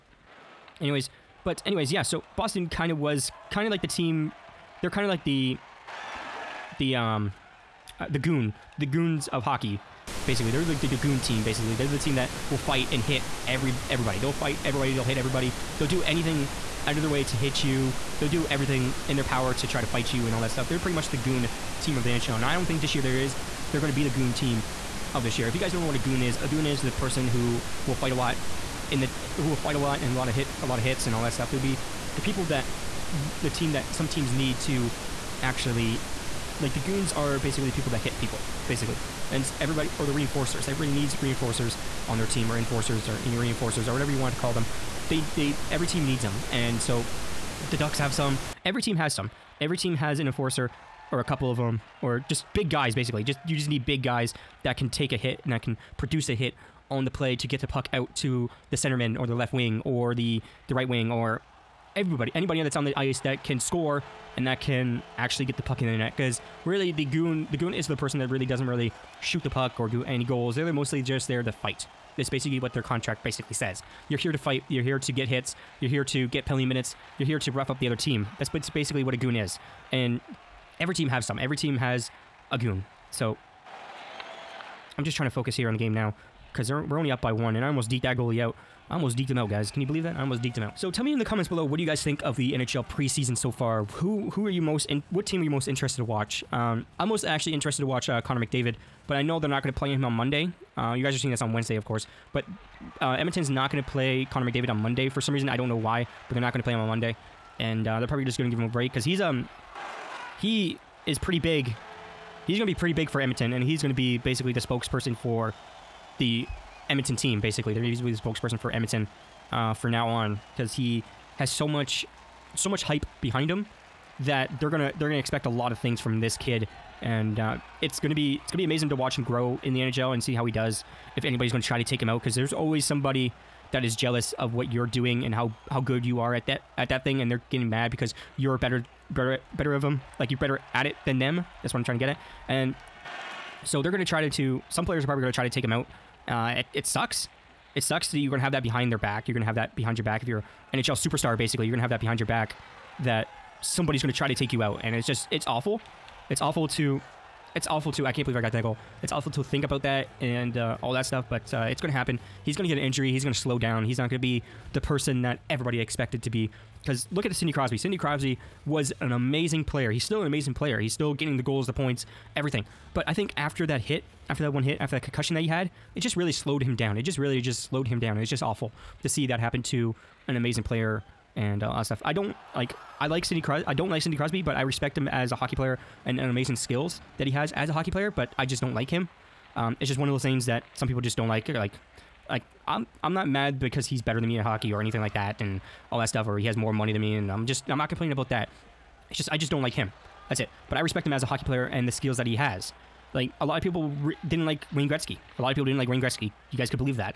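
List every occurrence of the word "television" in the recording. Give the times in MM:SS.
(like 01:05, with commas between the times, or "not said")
not said.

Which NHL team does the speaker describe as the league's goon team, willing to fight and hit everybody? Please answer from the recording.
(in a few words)
Boston.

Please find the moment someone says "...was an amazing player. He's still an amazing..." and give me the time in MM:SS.
02:48.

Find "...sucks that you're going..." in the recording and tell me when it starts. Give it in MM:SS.
02:27.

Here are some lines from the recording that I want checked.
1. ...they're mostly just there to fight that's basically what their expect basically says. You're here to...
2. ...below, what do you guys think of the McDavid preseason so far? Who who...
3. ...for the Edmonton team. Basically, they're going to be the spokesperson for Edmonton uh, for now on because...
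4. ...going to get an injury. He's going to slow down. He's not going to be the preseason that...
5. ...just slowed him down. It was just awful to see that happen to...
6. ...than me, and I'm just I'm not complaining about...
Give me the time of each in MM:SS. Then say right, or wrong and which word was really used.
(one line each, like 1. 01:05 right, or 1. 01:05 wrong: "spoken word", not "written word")
1. 01:10 wrong: "contract", not "expect"
2. 01:31 wrong: "NHL", not "McDavid"
3. 01:55 right
4. 02:42 wrong: "person", not "preseason"
5. 02:57 right
6. 03:16 right.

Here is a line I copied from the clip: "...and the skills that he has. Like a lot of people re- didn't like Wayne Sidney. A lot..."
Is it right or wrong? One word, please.
wrong.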